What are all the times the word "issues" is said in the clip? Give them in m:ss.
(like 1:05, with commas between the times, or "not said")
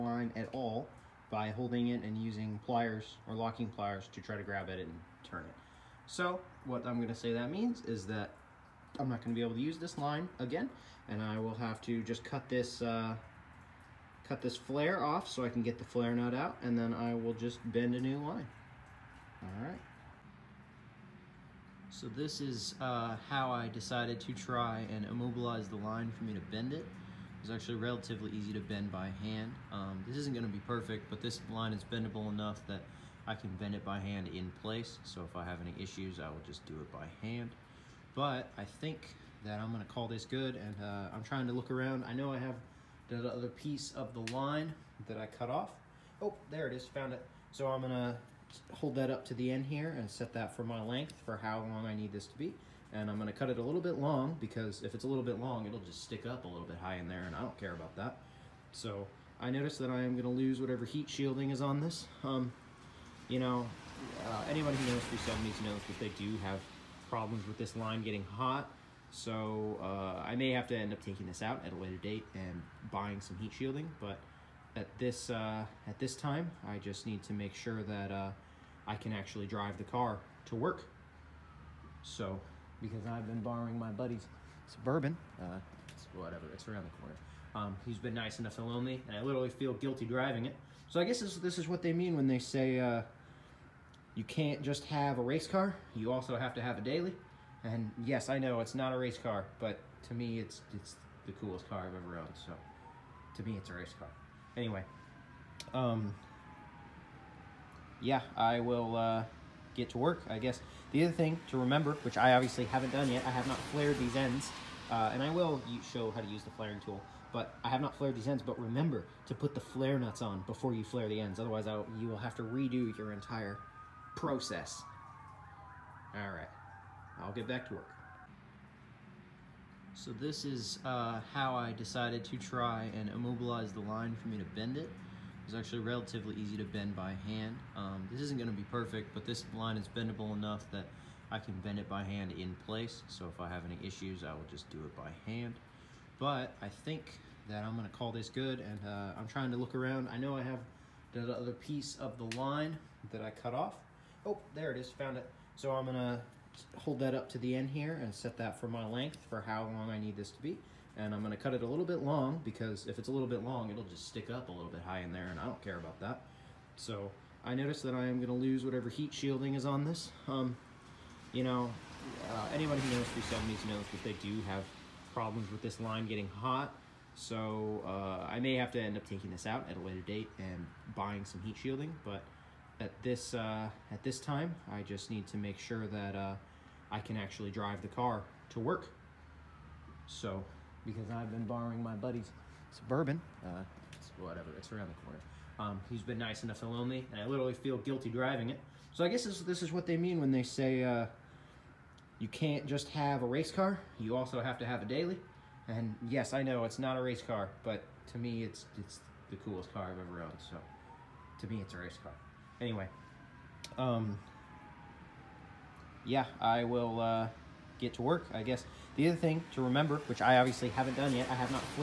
0:35, 2:23.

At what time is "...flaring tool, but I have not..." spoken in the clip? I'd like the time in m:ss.
1:56.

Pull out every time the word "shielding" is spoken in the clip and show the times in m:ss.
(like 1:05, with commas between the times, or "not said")
1:01, 1:13, 2:49, 3:01.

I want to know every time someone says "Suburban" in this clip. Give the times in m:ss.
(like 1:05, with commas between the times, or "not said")
1:24, 3:12.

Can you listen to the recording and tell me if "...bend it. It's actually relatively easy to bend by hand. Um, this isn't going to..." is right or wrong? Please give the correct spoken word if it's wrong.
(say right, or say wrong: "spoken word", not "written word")
right.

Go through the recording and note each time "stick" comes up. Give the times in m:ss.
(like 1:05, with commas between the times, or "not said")
0:56, 2:44.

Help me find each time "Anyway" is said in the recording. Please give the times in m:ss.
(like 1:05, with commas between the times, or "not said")
1:44, 3:32.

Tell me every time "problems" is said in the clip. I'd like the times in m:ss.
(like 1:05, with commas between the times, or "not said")
1:07, 2:55.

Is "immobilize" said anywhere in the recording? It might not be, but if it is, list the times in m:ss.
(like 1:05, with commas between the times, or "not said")
0:25, 2:13.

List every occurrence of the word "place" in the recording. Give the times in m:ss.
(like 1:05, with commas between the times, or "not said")
0:34, 2:22.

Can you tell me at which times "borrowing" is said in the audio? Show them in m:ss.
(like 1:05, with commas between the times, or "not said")
1:23, 3:11.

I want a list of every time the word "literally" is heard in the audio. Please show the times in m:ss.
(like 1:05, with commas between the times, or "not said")
1:29, 3:17.